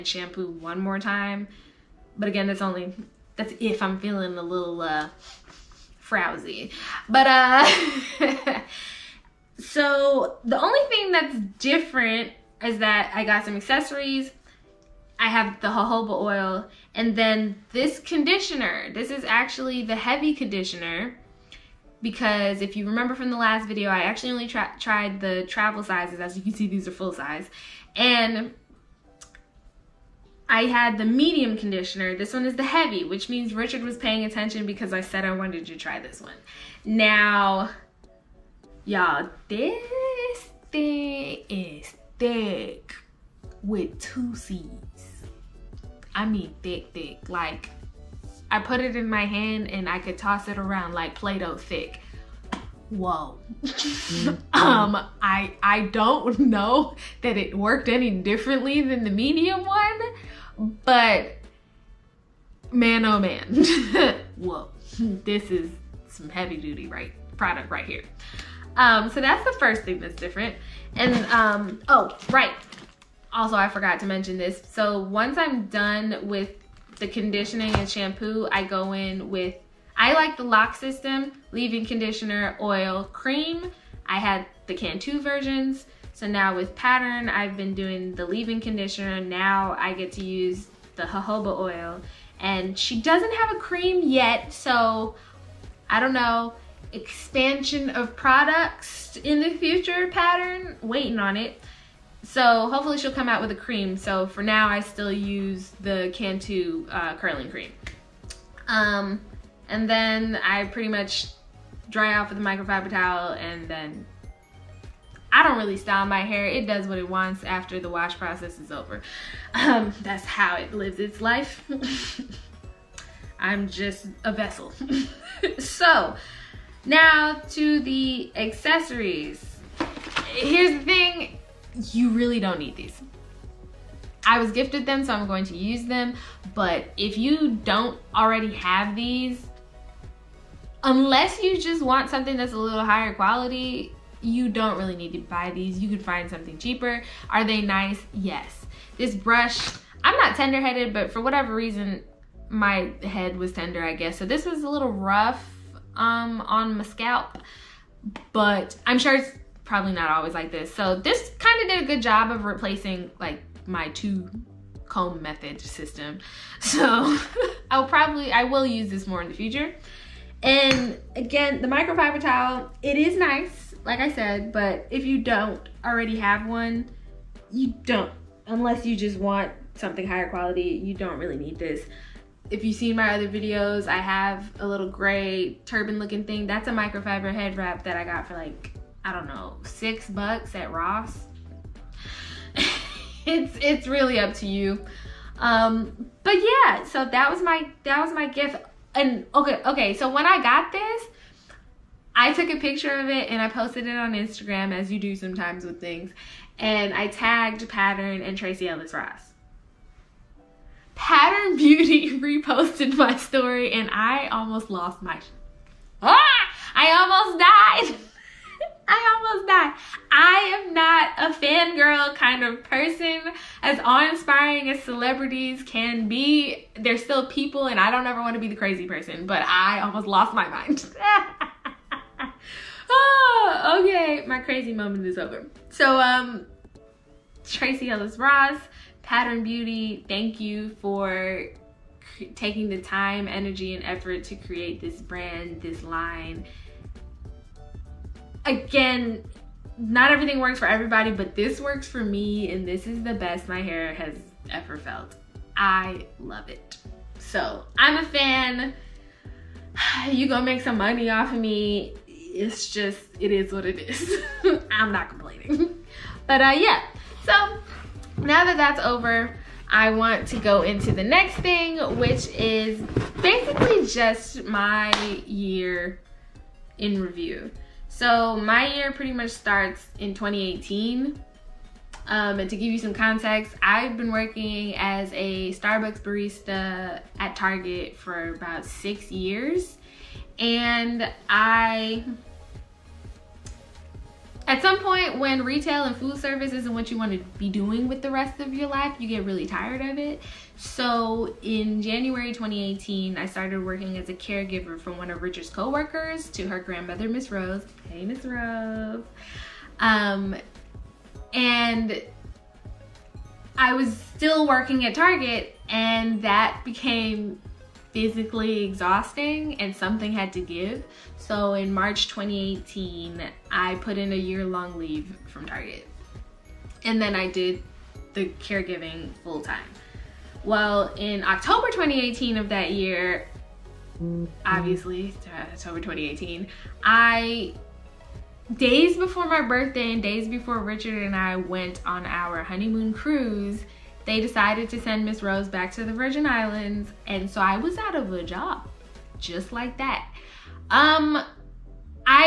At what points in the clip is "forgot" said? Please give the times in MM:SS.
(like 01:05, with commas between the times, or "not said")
01:13.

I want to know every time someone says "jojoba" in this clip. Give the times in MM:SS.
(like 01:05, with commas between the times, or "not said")
00:15, 01:31.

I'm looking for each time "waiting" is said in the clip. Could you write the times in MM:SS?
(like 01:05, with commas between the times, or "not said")
01:40.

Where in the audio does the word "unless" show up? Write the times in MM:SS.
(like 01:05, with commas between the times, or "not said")
02:20, 02:58.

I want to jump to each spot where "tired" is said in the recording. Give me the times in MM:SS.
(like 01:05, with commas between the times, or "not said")
04:59.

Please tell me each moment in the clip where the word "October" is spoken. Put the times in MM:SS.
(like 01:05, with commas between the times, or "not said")
05:31, 05:35.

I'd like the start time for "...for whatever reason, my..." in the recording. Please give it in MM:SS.
02:31.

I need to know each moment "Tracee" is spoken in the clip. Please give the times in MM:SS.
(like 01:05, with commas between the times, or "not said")
03:28, 03:57.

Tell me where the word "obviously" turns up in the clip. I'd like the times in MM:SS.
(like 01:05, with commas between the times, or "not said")
05:34.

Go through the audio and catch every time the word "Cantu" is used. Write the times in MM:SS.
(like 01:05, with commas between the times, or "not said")
01:24, 01:46.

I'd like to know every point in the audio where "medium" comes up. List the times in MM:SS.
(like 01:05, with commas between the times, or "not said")
00:31, 00:59.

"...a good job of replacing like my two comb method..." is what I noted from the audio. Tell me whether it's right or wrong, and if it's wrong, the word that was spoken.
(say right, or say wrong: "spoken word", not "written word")
right.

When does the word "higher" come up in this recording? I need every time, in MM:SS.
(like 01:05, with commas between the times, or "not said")
02:22, 03:00.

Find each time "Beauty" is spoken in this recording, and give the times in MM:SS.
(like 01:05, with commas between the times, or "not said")
03:31, 03:59.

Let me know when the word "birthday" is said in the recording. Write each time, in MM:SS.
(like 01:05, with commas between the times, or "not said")
05:39.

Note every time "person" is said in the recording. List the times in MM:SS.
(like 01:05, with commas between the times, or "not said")
03:42, 03:48.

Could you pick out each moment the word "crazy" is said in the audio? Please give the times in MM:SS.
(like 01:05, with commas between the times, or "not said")
03:48, 03:54.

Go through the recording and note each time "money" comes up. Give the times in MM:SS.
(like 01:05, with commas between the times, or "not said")
04:20.